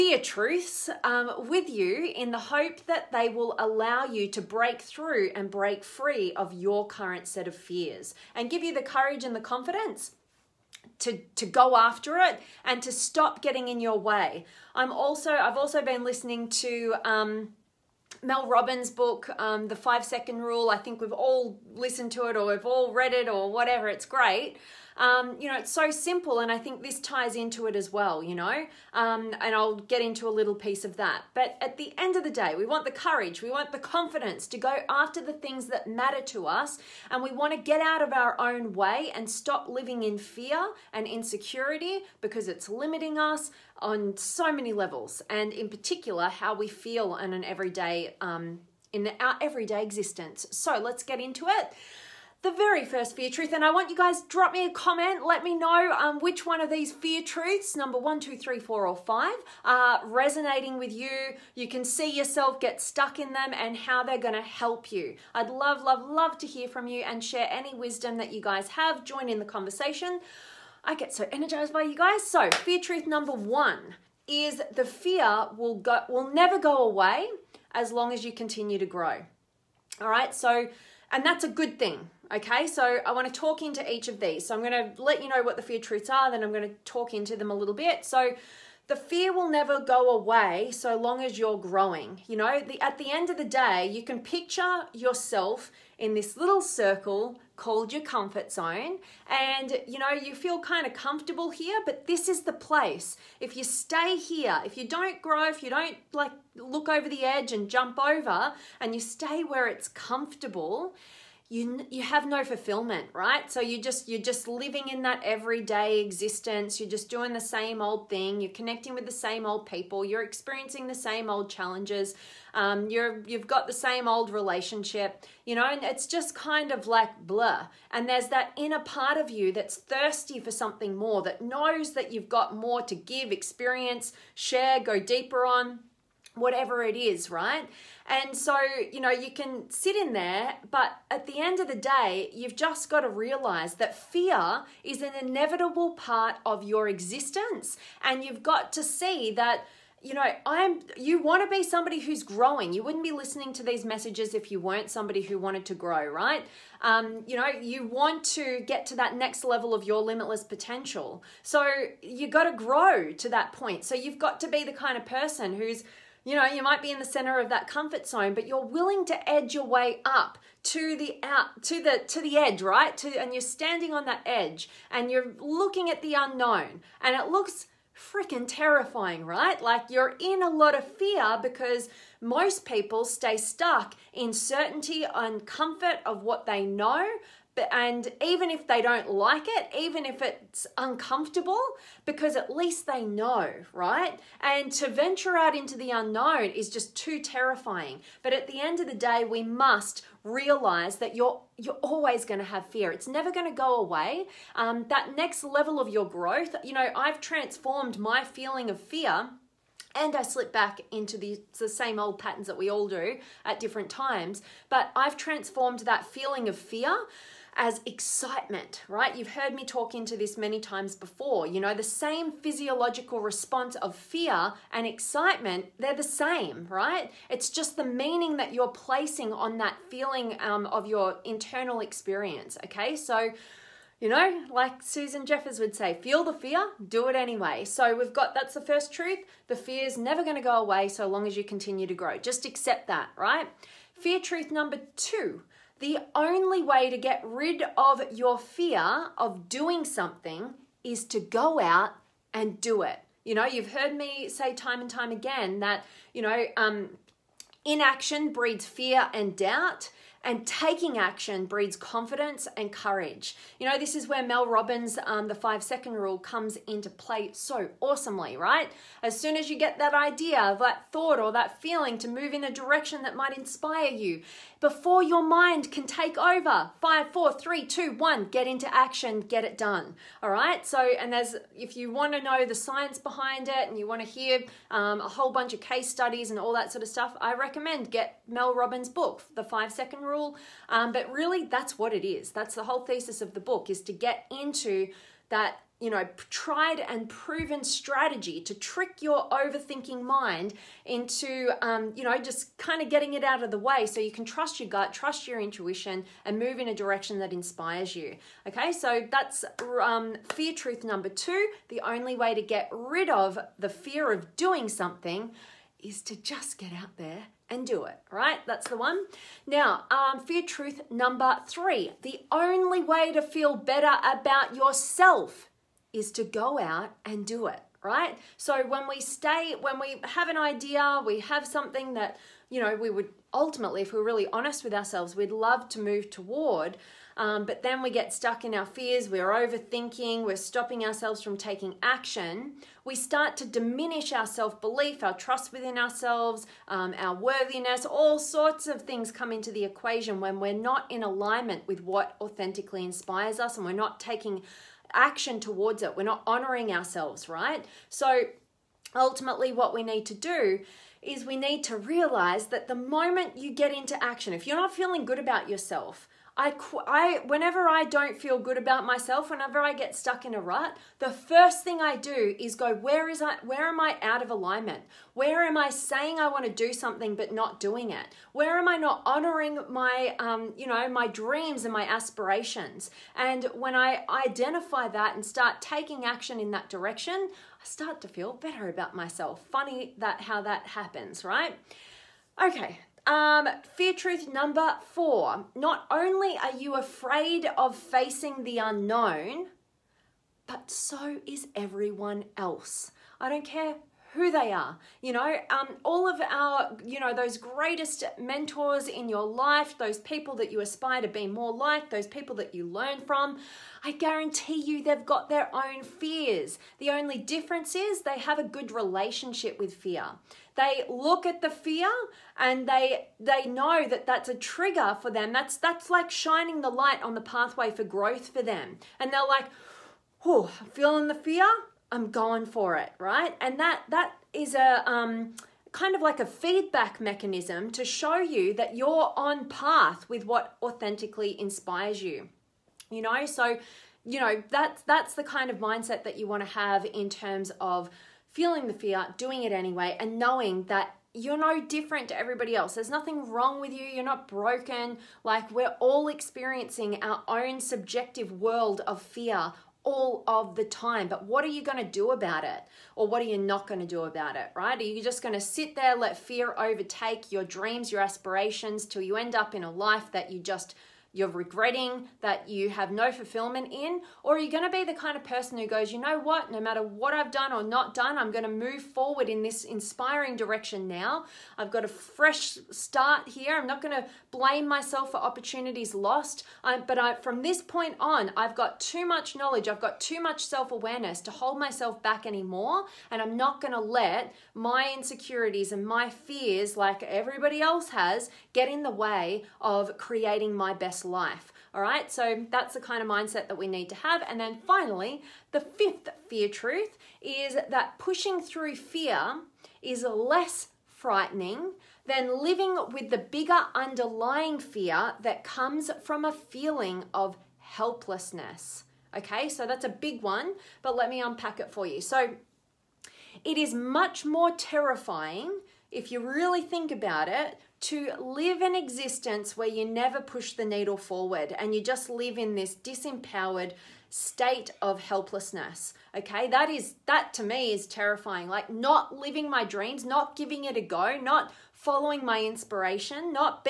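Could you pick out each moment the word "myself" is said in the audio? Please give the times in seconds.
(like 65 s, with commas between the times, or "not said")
368 s, 388 s, 484 s, 491 s.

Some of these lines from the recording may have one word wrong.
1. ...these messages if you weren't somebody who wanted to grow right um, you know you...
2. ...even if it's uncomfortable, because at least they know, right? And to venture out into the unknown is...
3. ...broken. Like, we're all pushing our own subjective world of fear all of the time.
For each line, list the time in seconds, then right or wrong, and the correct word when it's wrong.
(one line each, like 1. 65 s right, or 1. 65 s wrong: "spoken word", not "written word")
1. 153 s right
2. 189 s right
3. 454 s wrong: "experiencing", not "pushing".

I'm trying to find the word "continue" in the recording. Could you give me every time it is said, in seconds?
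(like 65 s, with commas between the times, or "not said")
78 s, 241 s.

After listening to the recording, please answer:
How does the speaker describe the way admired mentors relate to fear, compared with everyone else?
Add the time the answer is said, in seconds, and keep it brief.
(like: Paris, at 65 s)
a good relationship, at 418 s.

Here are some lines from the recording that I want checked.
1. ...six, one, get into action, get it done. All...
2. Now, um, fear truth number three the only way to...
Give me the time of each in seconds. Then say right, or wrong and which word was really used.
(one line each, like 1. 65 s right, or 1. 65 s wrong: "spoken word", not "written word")
1. 277 s wrong: "two", not "six"
2. 319 s right.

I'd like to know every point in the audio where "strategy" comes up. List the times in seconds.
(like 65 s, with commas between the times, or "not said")
297 s.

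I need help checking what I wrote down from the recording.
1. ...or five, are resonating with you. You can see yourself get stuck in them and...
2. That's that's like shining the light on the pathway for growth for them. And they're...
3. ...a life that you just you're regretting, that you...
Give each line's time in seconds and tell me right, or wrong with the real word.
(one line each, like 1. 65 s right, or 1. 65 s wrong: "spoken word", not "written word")
1. 58 s right
2. 425 s right
3. 469 s right.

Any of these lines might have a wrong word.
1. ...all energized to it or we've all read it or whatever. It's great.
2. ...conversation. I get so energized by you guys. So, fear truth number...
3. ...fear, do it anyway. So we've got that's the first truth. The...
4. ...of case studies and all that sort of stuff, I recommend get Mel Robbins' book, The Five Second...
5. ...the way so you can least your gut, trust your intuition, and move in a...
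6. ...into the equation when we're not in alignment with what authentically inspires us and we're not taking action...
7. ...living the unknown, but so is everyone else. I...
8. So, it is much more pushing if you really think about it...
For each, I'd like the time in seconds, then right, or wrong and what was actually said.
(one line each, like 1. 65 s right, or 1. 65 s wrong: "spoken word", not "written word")
1. 21 s wrong: "listened", not "energized"
2. 69 s right
3. 236 s right
4. 285 s right
5. 303 s wrong: "trust", not "least"
6. 349 s right
7. 397 s wrong: "facing", not "living"
8. 522 s wrong: "terrifying", not "pushing".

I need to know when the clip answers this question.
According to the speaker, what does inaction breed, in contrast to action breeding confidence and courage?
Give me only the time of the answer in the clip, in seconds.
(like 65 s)
258 s.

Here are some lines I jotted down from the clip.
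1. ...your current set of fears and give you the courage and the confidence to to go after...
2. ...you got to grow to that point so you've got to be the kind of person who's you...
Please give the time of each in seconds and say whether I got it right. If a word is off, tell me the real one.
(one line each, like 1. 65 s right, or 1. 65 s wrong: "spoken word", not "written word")
1. 6 s right
2. 162 s right.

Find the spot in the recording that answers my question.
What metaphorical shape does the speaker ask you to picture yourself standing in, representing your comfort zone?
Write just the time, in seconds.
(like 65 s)
96 s.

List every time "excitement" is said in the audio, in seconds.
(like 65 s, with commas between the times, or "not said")
217 s, 224 s.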